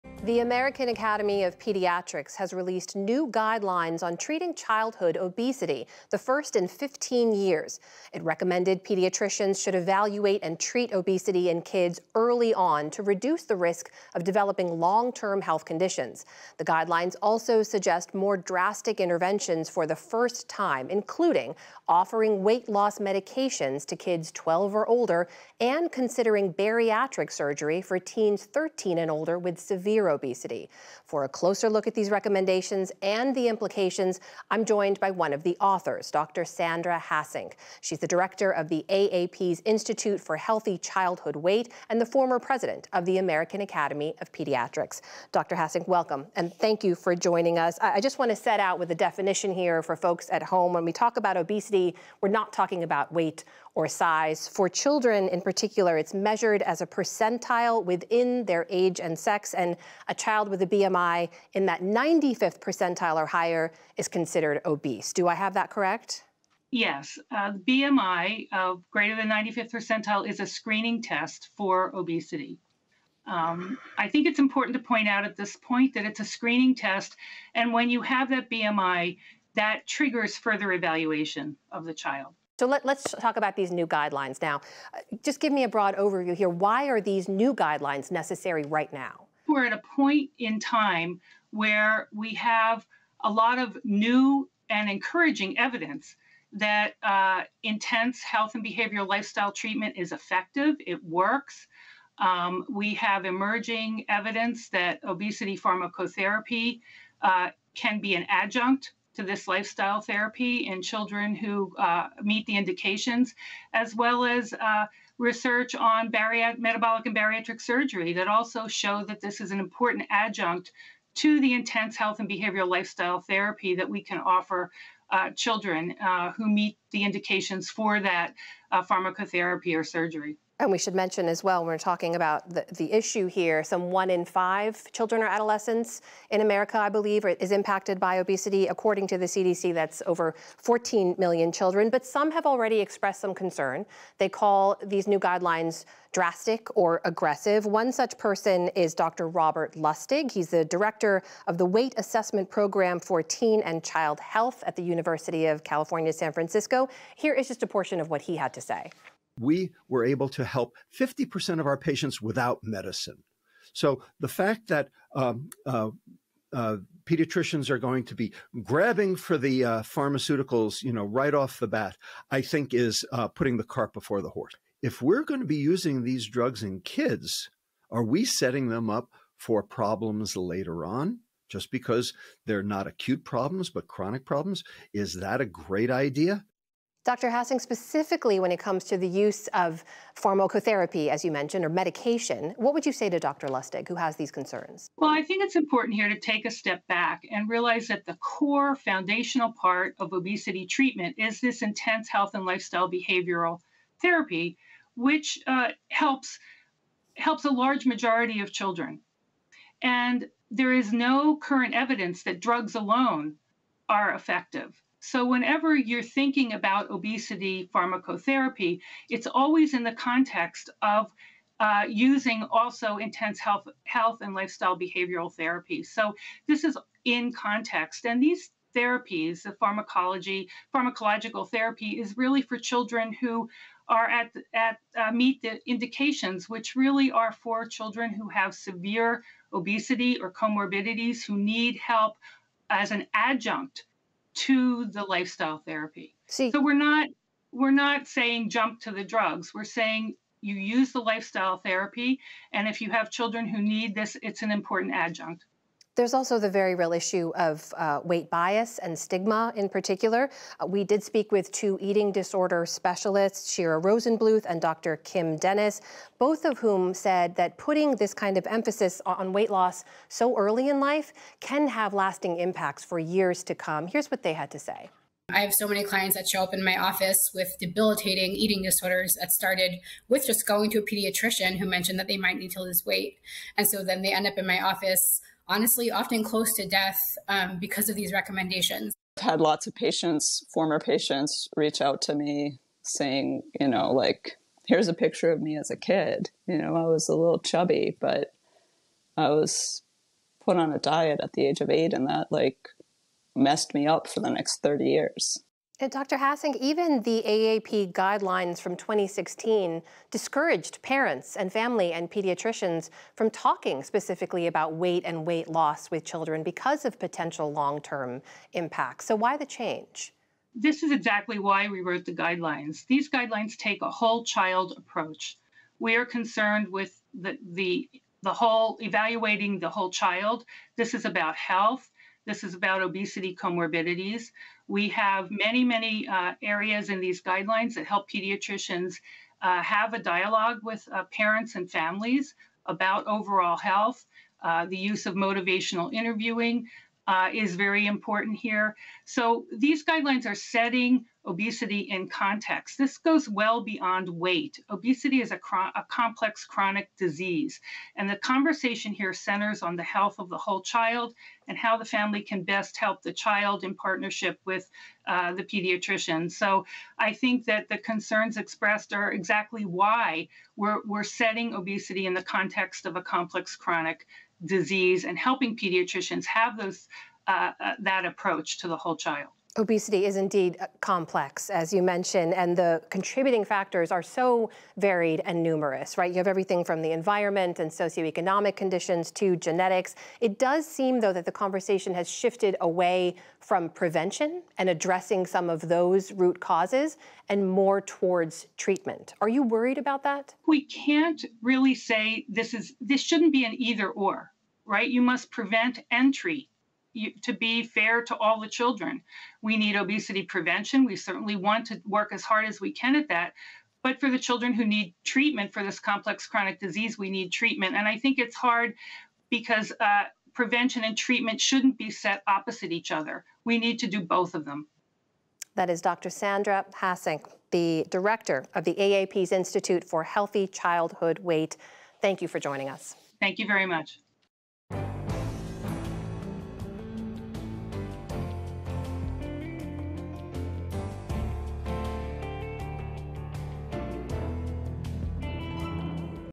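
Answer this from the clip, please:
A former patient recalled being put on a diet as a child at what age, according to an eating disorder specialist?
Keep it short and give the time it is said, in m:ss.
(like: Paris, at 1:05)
8, at 5:01.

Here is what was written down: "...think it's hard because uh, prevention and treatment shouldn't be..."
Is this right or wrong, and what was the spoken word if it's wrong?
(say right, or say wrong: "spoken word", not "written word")
right.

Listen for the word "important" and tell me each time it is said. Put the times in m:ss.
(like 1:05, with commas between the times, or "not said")
1:14, 1:59, 3:15, 4:14, 5:47.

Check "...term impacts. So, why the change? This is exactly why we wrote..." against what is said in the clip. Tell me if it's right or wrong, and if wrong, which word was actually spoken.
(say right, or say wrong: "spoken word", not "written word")
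right.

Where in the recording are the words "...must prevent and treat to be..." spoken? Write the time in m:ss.
6:45.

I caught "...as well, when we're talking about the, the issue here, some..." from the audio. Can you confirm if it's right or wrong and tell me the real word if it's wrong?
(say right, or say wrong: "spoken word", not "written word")
right.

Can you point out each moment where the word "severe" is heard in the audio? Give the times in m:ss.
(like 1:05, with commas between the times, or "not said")
0:29, 3:58.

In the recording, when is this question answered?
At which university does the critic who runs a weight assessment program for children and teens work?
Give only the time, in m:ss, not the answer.
2:34.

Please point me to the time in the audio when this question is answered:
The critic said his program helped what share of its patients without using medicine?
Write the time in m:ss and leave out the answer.
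2:40.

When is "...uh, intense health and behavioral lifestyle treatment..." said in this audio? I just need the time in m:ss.
1:37.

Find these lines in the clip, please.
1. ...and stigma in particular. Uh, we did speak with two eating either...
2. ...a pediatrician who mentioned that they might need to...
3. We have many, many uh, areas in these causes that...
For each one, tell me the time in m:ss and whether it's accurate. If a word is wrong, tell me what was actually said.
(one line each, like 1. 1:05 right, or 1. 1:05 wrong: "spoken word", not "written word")
1. 4:18 wrong: "disorder", not "either"
2. 4:40 right
3. 5:34 wrong: "guidelines", not "causes".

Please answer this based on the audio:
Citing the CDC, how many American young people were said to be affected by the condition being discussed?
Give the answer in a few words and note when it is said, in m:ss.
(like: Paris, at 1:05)
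over 14 million, at 2:20.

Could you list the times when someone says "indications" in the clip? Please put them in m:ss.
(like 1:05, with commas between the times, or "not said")
1:52, 2:07, 3:55.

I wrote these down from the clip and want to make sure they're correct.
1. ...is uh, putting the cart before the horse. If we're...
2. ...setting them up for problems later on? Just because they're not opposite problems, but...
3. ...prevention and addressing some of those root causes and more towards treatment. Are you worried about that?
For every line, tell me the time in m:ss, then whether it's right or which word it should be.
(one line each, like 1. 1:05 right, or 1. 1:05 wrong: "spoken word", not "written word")
1. 2:52 right
2. 2:58 wrong: "acute", not "opposite"
3. 6:33 right.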